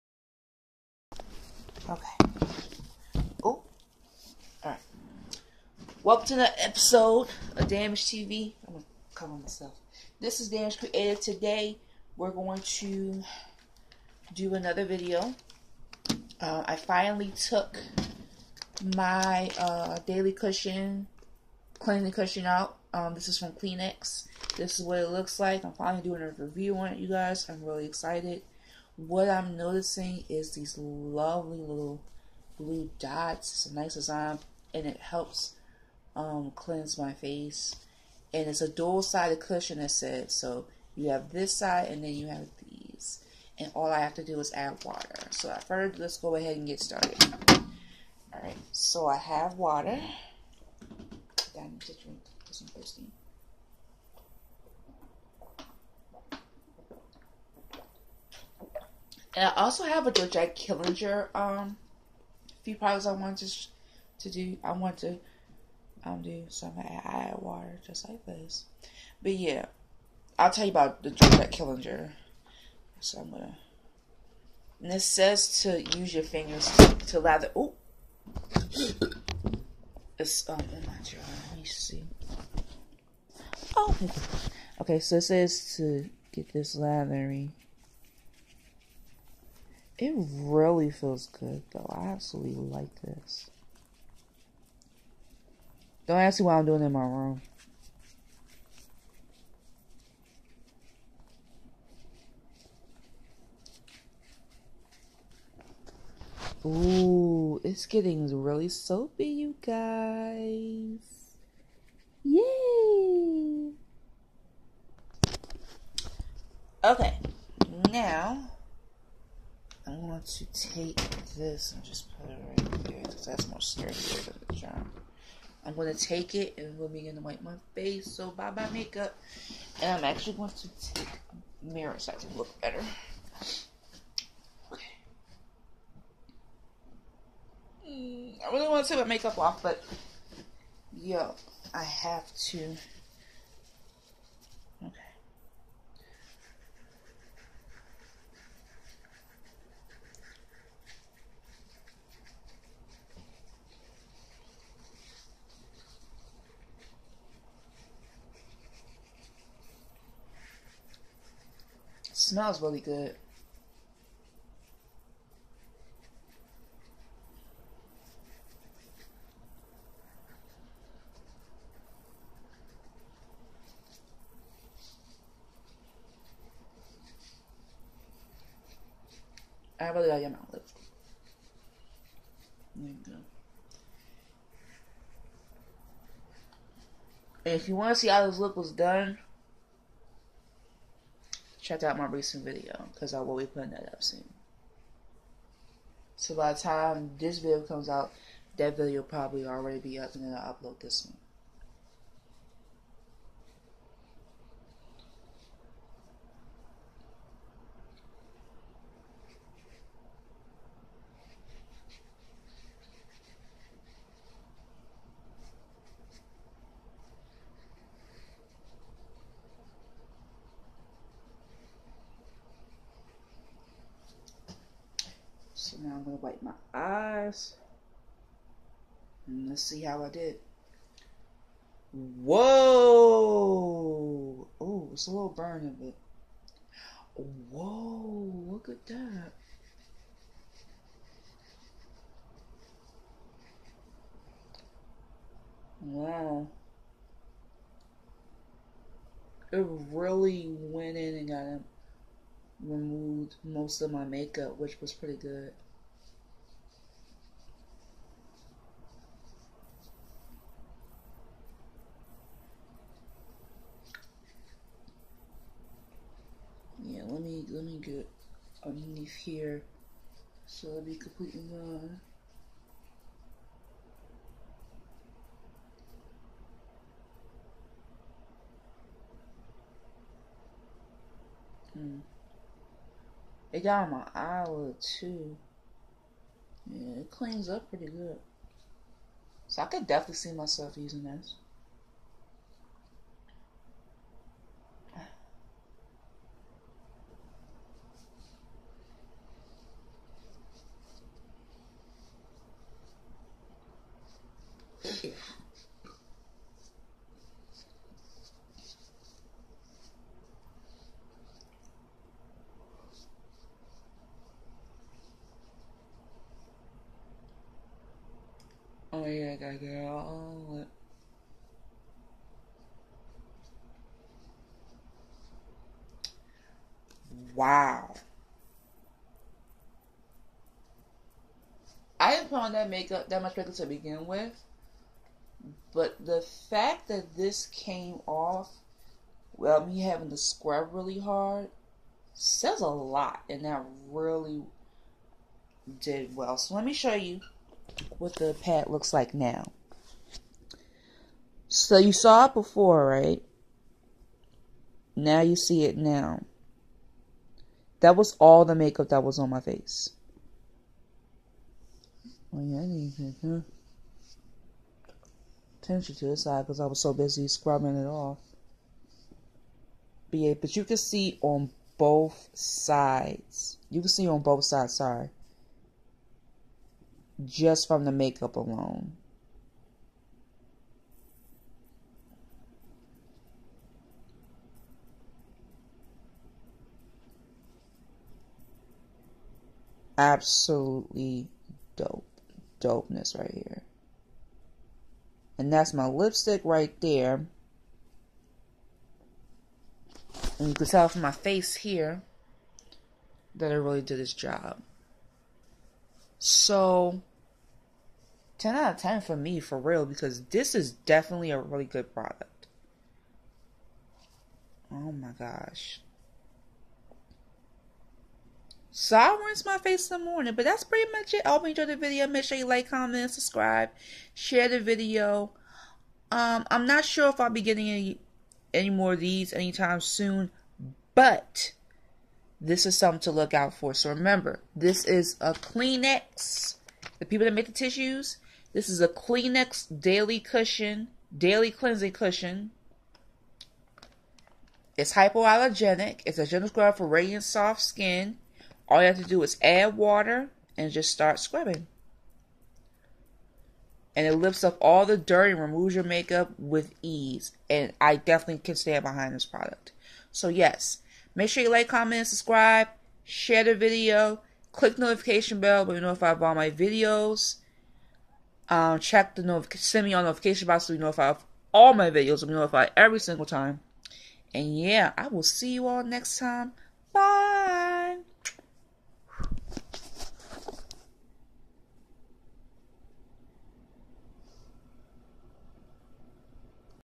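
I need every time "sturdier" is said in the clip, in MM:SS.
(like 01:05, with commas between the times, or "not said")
02:03.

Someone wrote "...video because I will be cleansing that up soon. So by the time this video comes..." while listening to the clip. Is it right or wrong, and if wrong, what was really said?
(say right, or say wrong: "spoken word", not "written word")
wrong: "putting", not "cleansing".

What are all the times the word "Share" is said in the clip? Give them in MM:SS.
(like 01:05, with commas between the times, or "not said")
07:04, 07:43.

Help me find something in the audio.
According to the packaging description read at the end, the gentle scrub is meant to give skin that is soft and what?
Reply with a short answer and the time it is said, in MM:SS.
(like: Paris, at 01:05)
Radiant, at 07:26.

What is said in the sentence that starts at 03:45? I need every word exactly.
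now I'm gonna wipe my eyes.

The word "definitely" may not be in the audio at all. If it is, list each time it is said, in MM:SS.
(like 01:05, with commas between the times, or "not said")
04:49, 06:50, 07:37.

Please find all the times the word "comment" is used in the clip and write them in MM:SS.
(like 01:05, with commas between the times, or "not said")
07:02, 07:41.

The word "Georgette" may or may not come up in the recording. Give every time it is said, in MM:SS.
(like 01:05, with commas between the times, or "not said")
01:00, 01:11.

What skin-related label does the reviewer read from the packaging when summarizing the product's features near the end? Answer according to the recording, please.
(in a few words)
Hypoallergenic.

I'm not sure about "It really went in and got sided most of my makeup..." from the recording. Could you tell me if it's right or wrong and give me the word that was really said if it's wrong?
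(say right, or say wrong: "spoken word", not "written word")
wrong: "removed", not "sided".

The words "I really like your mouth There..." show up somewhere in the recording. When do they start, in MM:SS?
02:59.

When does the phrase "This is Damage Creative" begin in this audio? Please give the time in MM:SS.
00:10.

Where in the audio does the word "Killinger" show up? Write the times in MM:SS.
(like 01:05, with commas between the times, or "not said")
01:00, 01:11.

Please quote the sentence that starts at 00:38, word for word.
And it's a dual sided cushion, it said.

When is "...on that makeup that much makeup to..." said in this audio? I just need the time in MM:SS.
05:32.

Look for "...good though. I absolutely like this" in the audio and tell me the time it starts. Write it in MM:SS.
01:31.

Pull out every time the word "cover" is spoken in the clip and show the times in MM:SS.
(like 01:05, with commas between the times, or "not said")
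00:09.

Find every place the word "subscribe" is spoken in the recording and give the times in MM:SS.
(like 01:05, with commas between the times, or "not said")
07:03, 07:42.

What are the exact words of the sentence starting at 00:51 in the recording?
I need to drink because I'm thirsty.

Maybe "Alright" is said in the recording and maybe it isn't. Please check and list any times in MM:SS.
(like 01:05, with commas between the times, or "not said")
00:04, 00:48.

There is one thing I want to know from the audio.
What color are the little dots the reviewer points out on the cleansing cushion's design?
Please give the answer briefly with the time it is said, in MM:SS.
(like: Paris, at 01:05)
Blue, at 00:32.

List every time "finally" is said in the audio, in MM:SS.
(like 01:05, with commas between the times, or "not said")
00:16, 00:25.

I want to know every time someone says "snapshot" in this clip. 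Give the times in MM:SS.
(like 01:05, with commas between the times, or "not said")
not said.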